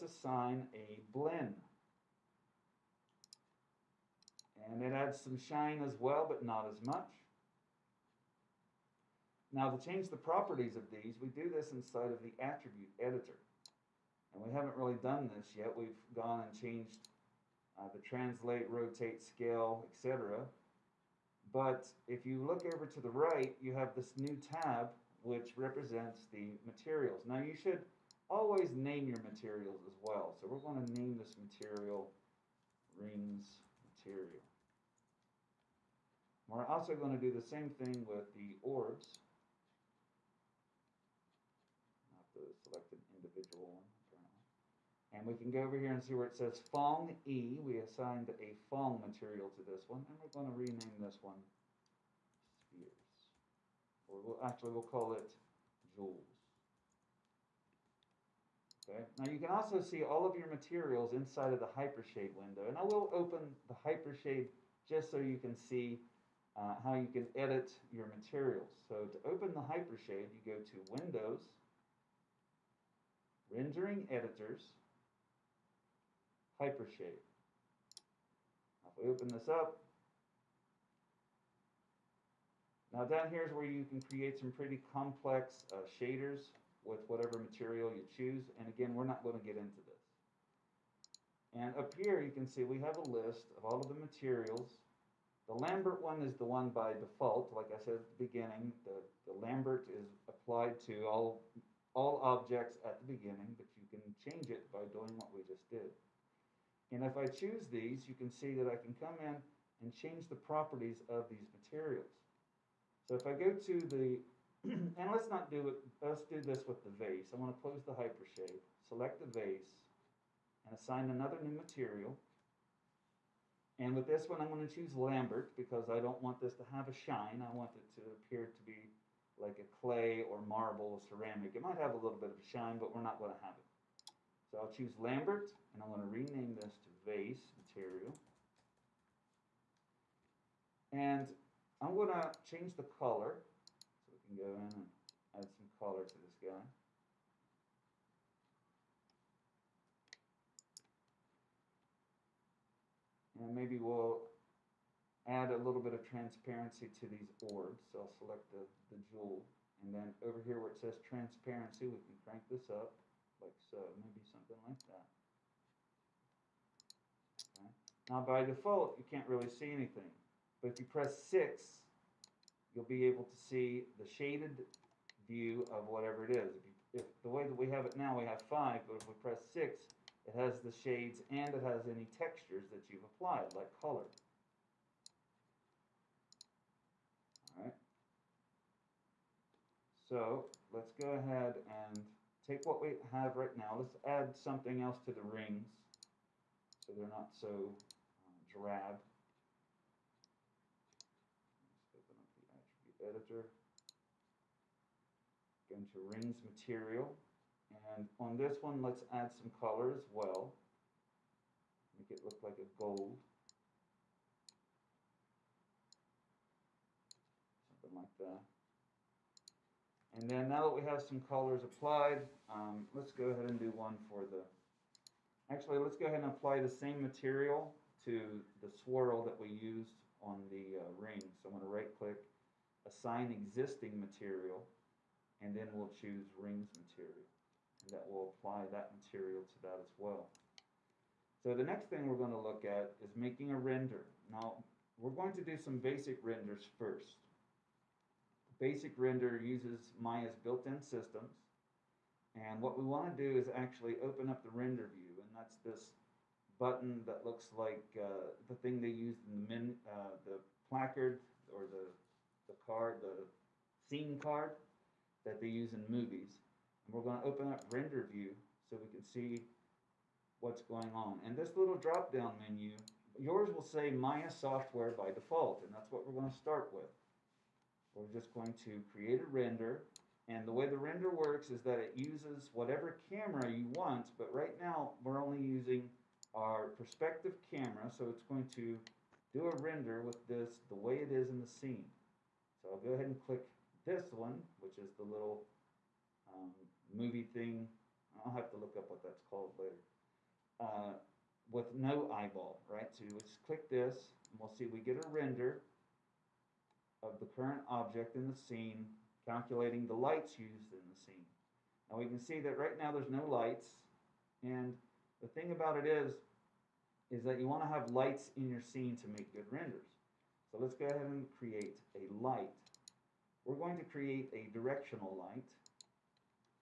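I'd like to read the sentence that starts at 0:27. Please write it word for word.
Now you should Always name your materials as well.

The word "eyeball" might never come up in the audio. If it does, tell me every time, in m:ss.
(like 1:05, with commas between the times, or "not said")
5:02.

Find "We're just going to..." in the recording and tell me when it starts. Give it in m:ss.
4:37.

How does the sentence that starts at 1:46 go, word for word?
And if I choose these, you can see that I can come in and change the properties of these materials.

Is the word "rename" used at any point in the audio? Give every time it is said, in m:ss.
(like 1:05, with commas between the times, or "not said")
0:50, 2:16.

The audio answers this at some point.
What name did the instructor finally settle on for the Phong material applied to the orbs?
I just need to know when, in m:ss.
0:55.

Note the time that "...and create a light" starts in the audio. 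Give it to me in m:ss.
5:21.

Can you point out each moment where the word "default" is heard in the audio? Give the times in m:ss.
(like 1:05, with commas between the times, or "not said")
1:36, 2:48, 4:35.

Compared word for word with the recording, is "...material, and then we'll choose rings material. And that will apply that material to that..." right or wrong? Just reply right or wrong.
right.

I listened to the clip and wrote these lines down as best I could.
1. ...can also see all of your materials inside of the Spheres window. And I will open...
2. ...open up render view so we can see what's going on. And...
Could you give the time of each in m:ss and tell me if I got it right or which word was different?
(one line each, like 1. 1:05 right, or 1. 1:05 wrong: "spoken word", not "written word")
1. 0:59 wrong: "Hypershade", not "Spheres"
2. 4:27 right.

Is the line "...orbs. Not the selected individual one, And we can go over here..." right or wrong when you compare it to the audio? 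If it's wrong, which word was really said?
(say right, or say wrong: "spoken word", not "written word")
right.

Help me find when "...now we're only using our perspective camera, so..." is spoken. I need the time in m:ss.
4:44.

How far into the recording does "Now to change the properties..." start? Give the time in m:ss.
0:09.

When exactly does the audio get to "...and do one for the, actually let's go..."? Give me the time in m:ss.
3:43.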